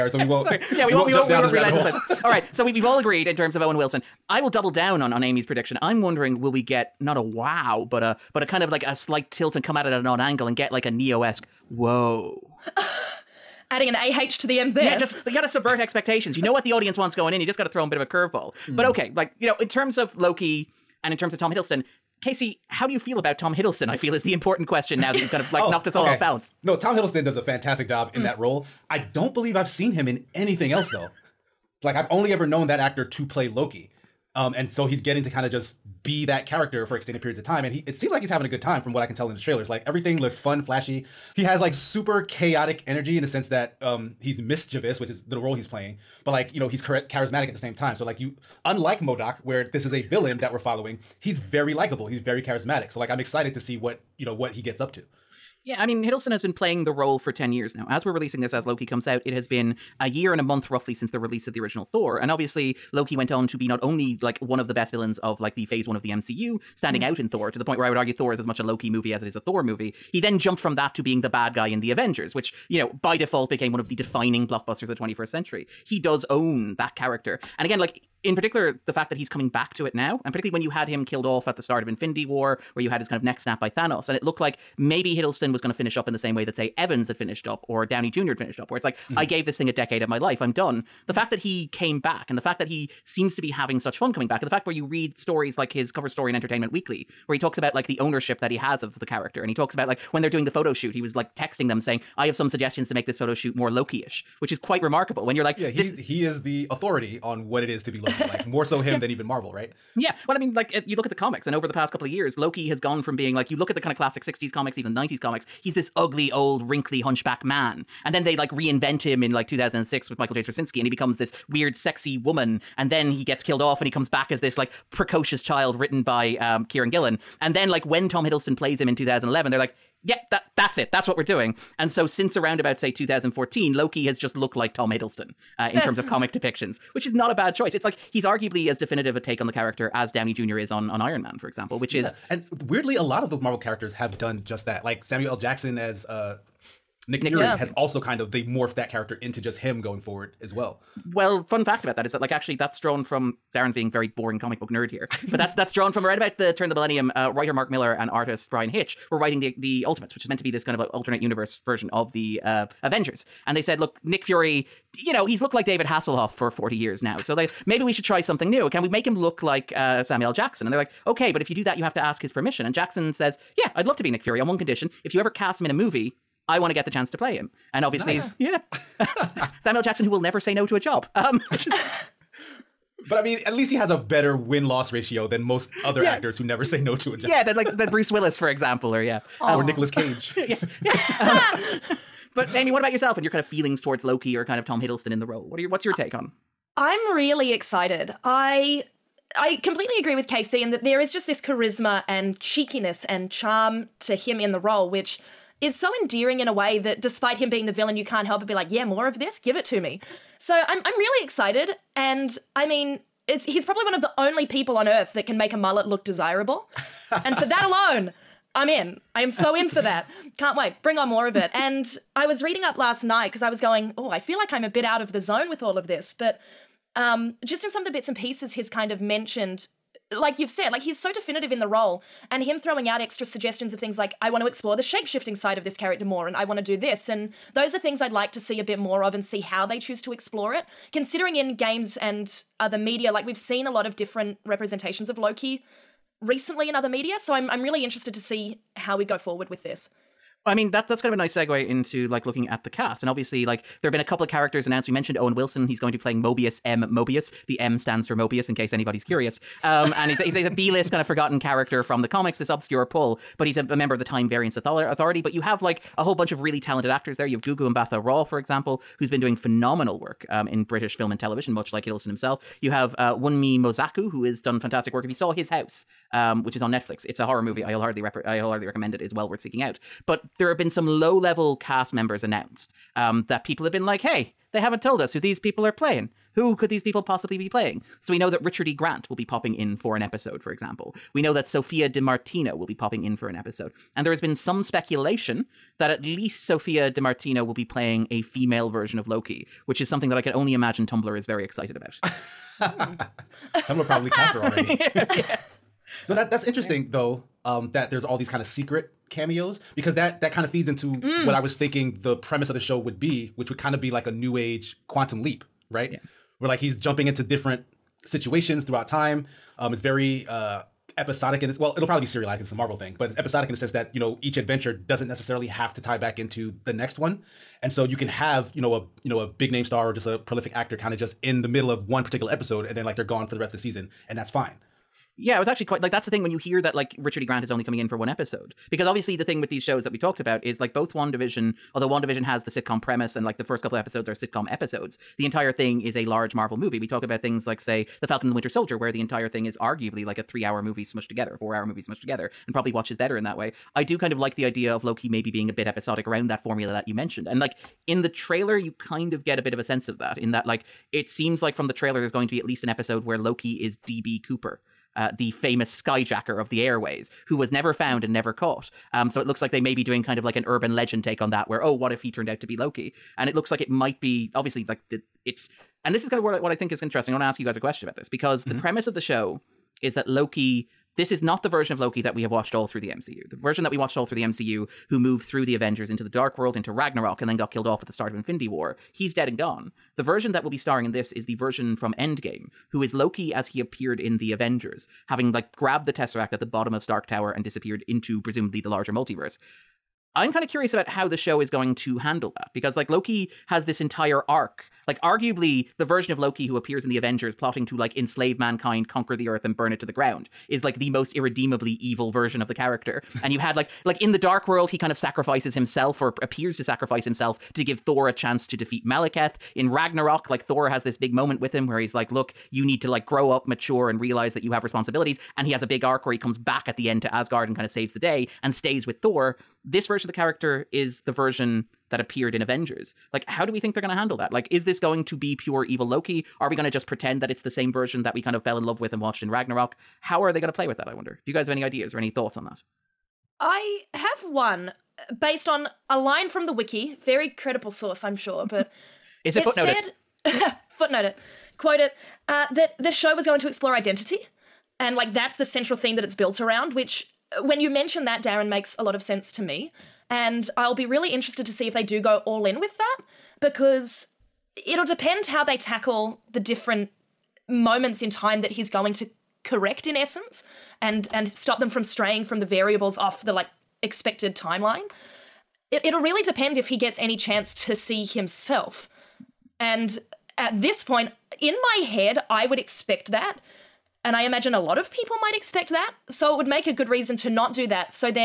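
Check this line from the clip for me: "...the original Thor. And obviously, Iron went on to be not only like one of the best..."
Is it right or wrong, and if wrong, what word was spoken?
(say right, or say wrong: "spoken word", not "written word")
wrong: "Loki", not "Iron".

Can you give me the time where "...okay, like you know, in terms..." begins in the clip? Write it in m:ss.
0:18.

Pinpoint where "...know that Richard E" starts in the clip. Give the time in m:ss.
4:48.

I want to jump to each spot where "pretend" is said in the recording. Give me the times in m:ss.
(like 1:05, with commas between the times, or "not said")
7:16.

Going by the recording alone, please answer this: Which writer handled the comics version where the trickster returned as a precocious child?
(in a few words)
Kieran Gillen.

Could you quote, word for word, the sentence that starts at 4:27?
You have Gugu Mbatha-Raw, for example, who's been doing phenomenal work um, in British film and television, much like Hiddleston himself.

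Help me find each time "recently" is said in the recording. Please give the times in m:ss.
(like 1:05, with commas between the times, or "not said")
4:06.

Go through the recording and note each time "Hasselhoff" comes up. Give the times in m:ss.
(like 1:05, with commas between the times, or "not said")
2:45.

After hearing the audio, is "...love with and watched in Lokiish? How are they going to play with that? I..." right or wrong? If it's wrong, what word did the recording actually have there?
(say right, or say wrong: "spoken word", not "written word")
wrong: "Ragnarok", not "Lokiish".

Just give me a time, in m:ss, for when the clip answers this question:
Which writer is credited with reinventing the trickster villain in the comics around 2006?
2:00.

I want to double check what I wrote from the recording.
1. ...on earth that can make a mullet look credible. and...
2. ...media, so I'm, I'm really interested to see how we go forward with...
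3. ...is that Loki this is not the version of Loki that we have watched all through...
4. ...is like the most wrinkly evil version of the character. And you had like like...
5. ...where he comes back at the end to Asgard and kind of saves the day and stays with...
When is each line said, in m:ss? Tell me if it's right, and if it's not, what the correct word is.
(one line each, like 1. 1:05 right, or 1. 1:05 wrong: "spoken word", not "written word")
1. 3:34 wrong: "desirable", not "credible"
2. 4:06 right
3. 6:19 right
4. 6:50 wrong: "irredeemably", not "wrinkly"
5. 7:06 right.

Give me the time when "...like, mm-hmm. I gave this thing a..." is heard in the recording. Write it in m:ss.
1:28.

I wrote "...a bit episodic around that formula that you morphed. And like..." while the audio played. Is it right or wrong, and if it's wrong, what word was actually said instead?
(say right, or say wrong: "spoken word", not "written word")
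wrong: "mentioned", not "morphed".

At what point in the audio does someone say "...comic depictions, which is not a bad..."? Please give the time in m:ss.
2:16.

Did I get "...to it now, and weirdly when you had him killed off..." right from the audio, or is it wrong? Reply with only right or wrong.
wrong.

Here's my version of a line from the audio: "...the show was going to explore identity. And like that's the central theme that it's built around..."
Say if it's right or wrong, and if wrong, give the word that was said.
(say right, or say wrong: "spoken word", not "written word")
right.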